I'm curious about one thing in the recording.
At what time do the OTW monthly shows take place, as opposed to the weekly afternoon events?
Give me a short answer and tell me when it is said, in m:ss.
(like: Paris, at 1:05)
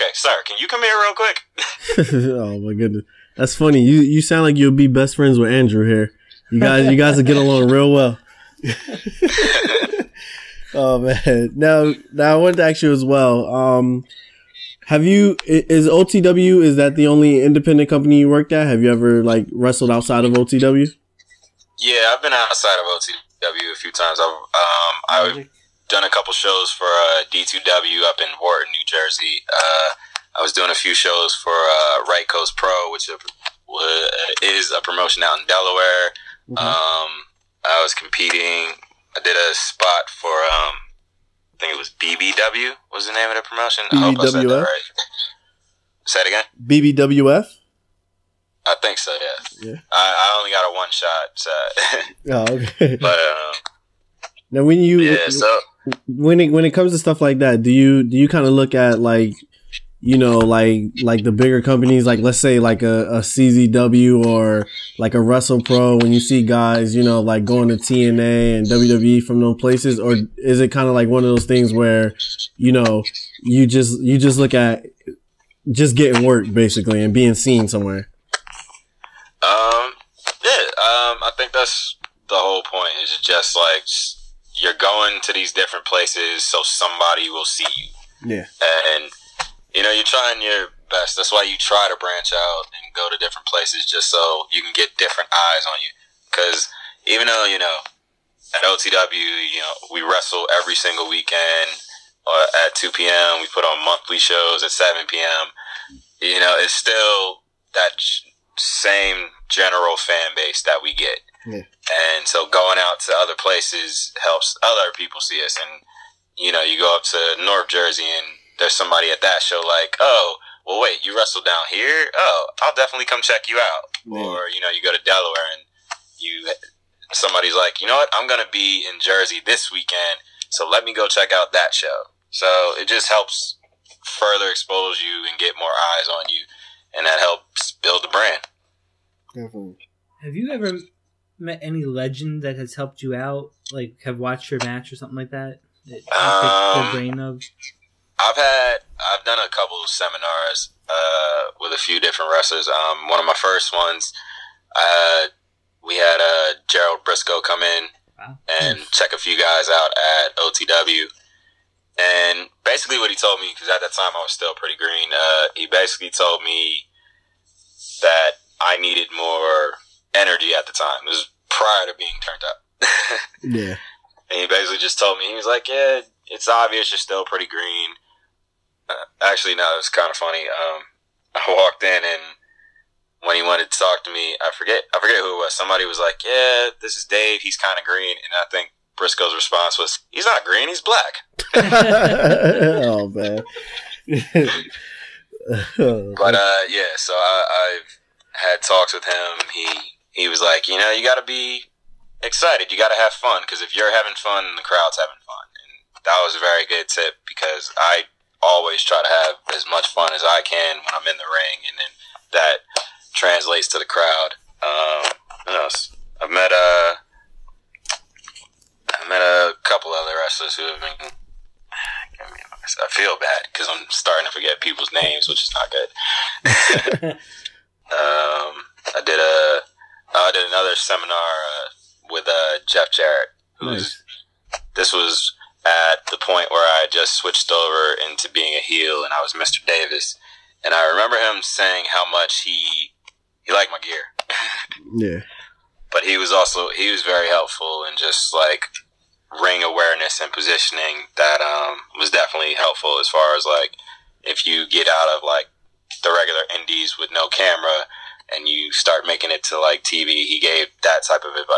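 7 p.m., at 1:44.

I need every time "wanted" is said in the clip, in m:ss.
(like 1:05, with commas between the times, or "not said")
0:12, 3:03.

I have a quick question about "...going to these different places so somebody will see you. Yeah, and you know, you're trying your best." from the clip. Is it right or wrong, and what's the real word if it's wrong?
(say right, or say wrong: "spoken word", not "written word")
right.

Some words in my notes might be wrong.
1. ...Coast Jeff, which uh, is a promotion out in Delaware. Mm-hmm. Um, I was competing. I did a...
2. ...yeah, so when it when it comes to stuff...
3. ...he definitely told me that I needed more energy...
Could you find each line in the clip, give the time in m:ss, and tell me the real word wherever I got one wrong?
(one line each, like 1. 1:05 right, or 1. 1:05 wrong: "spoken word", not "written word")
1. 0:32 wrong: "Pro", not "Jeff"
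2. 0:54 right
3. 2:45 wrong: "basically", not "definitely".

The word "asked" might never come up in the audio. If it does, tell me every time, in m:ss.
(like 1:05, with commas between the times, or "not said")
not said.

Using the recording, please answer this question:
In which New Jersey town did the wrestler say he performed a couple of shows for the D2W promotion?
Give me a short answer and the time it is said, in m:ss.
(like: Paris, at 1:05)
Wharton, at 0:28.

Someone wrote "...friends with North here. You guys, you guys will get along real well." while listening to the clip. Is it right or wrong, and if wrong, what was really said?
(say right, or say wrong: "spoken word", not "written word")
wrong: "Andrew", not "North".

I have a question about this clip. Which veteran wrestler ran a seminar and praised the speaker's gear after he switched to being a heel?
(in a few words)
Jeff Jarrett.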